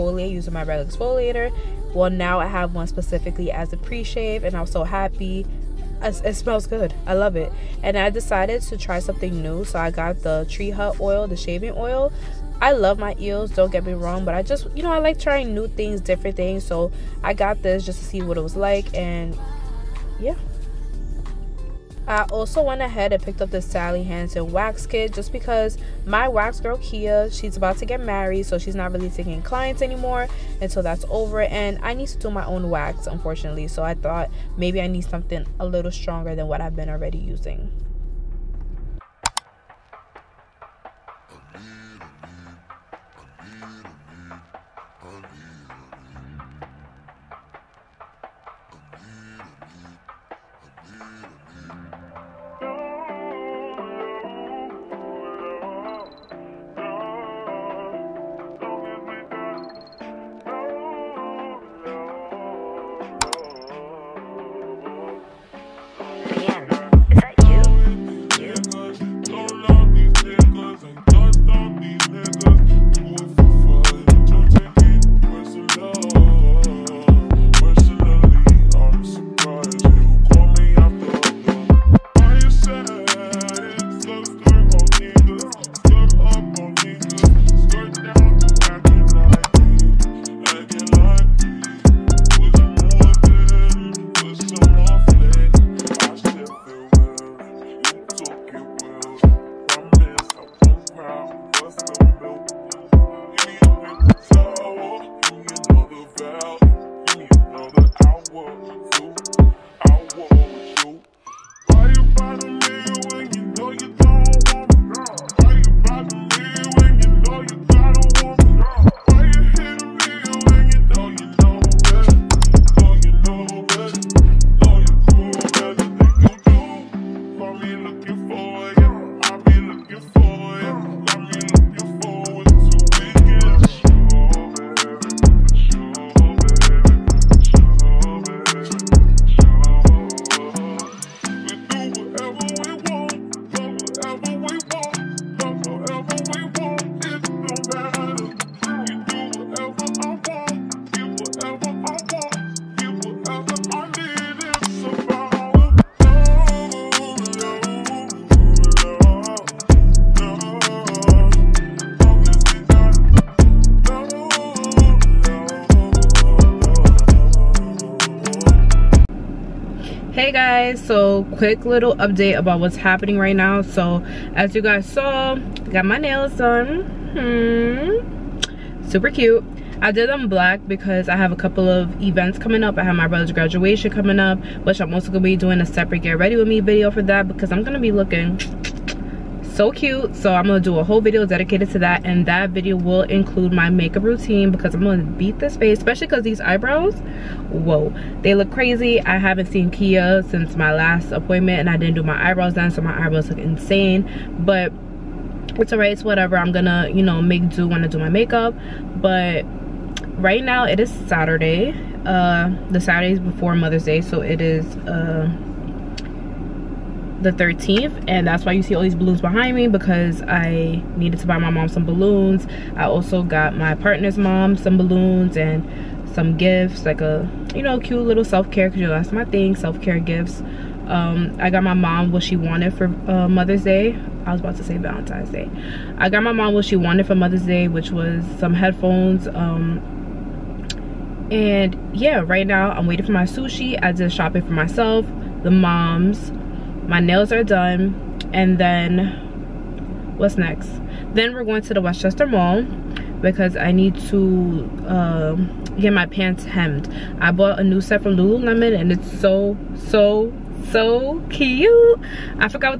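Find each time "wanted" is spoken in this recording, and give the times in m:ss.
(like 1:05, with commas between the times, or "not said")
3:52, 3:56.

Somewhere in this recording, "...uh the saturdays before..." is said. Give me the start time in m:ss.
3:32.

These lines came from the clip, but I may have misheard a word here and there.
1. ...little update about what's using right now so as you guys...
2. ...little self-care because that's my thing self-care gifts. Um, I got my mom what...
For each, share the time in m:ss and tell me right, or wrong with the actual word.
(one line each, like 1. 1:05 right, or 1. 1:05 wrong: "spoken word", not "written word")
1. 2:51 wrong: "happening", not "using"
2. 3:48 right.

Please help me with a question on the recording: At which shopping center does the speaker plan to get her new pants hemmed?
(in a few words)
Westchester Mall.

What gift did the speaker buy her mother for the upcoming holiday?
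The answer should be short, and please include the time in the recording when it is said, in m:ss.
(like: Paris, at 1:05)
Headphones, at 3:58.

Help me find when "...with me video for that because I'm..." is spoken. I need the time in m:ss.
3:06.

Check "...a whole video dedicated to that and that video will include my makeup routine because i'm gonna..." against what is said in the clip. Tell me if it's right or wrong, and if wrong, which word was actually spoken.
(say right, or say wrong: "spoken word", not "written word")
right.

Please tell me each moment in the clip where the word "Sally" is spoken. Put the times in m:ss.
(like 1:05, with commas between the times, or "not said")
0:23.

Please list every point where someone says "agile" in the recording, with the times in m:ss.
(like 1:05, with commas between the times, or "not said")
not said.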